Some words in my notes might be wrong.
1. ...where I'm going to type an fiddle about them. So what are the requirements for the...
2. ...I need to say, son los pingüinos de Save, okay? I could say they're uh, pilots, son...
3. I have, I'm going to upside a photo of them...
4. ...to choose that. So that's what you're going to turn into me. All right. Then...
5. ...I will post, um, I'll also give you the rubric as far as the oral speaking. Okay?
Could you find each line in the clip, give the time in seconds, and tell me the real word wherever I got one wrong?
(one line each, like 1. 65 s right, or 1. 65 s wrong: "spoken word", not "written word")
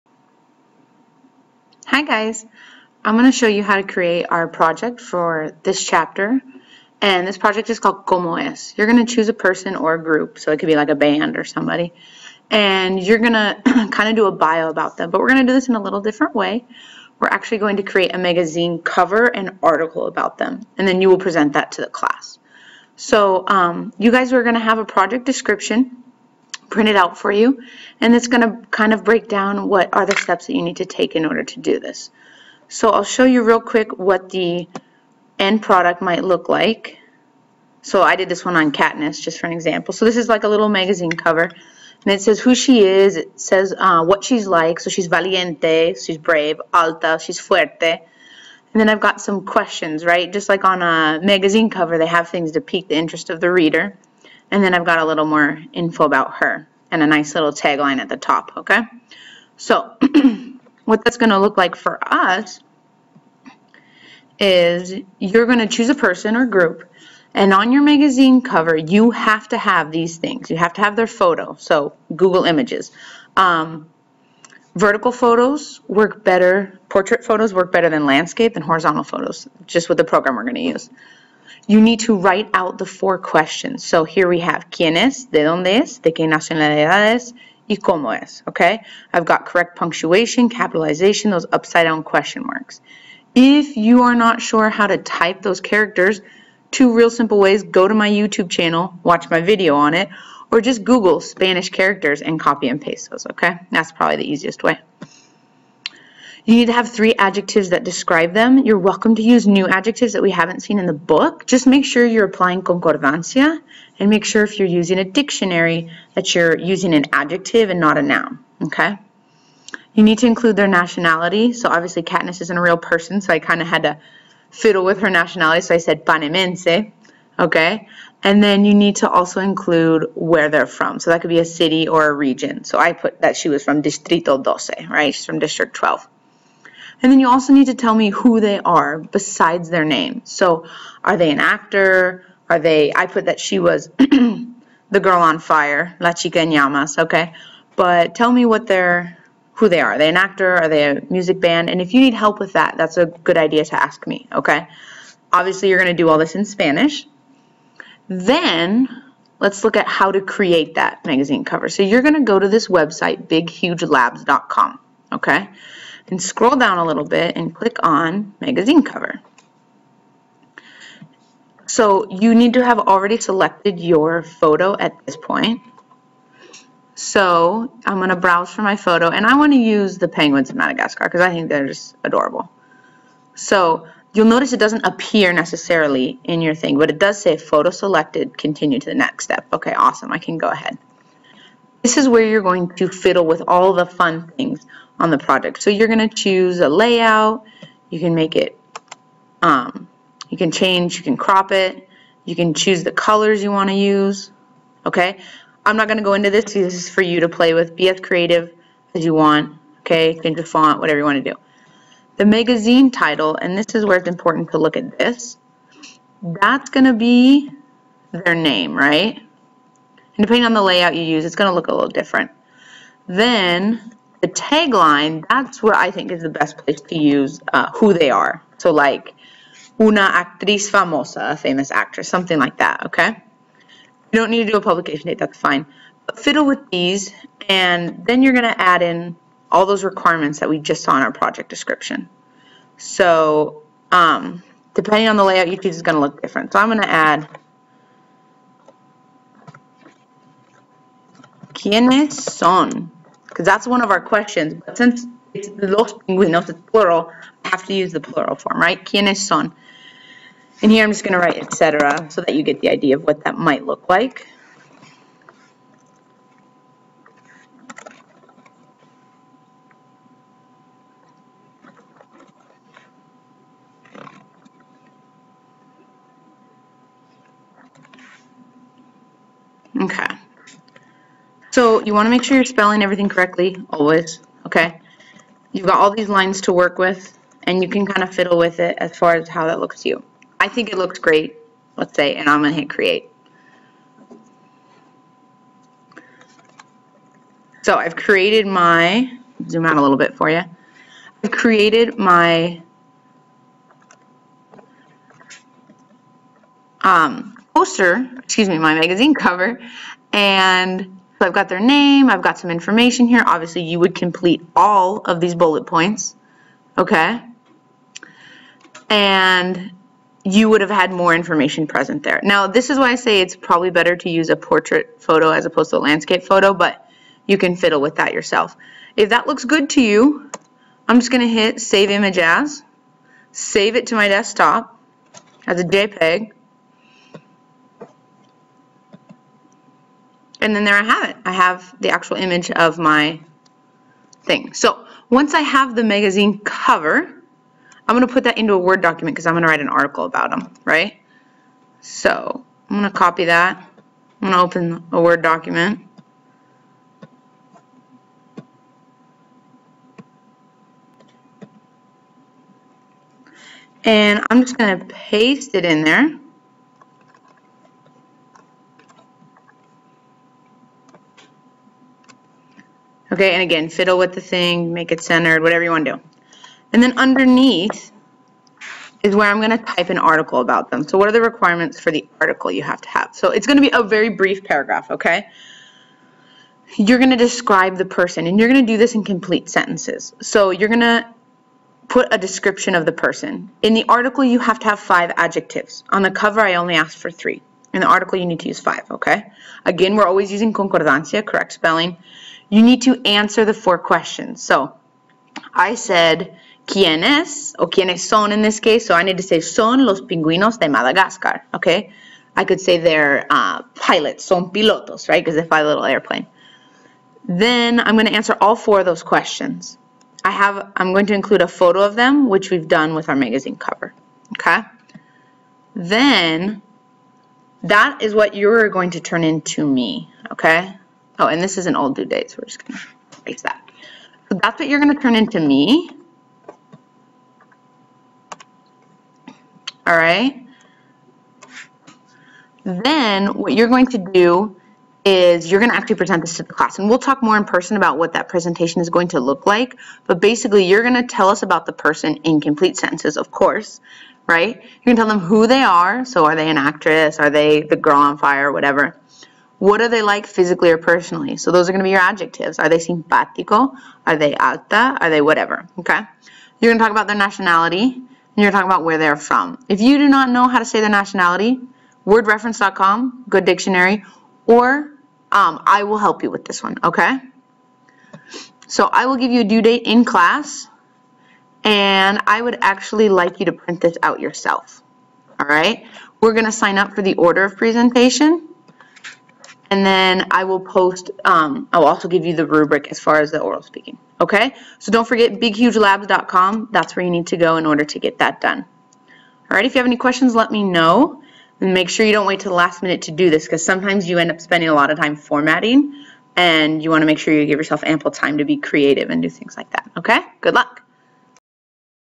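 1. 379 s wrong: "article", not "fiddle"
2. 408 s wrong: "Madagascar", not "Save"
3. 420 s wrong: "include", not "upside"
4. 432 s wrong: "erase", not "choose"
5. 490 s right.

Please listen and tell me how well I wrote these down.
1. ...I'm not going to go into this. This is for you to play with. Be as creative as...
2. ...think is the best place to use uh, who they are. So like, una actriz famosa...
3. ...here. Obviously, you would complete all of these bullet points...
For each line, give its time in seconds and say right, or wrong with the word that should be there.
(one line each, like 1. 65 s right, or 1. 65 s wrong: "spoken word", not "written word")
1. 205 s right
2. 225 s right
3. 313 s right.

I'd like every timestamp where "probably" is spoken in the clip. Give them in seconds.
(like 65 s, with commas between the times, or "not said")
103 s, 323 s.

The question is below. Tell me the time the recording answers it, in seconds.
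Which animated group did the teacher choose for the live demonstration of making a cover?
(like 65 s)
180 s.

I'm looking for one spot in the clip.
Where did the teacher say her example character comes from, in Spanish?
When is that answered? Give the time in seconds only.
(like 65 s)
133 s.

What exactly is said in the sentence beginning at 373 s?
Okay, and again, fiddle with the thing, make it centered, whatever you want to do.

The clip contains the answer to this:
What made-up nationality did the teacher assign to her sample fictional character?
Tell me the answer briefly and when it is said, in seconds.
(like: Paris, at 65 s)
panemense, at 126 s.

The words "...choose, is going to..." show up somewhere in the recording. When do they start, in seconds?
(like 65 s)
245 s.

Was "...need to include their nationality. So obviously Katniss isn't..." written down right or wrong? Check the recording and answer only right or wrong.
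right.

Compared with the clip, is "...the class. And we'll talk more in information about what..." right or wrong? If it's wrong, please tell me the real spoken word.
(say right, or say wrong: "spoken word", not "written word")
wrong: "person", not "information".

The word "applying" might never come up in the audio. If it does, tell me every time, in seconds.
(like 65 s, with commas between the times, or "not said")
112 s.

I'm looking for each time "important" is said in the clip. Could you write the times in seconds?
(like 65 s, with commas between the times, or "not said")
214 s.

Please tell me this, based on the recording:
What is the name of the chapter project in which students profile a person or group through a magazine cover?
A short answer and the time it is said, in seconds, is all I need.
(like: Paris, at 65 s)
Como Es, at 8 s.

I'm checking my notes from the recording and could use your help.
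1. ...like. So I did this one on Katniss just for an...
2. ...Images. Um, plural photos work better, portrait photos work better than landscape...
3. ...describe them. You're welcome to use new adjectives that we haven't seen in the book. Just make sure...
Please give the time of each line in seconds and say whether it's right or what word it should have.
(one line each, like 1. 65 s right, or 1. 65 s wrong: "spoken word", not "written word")
1. 36 s right
2. 72 s wrong: "vertical", not "plural"
3. 107 s right.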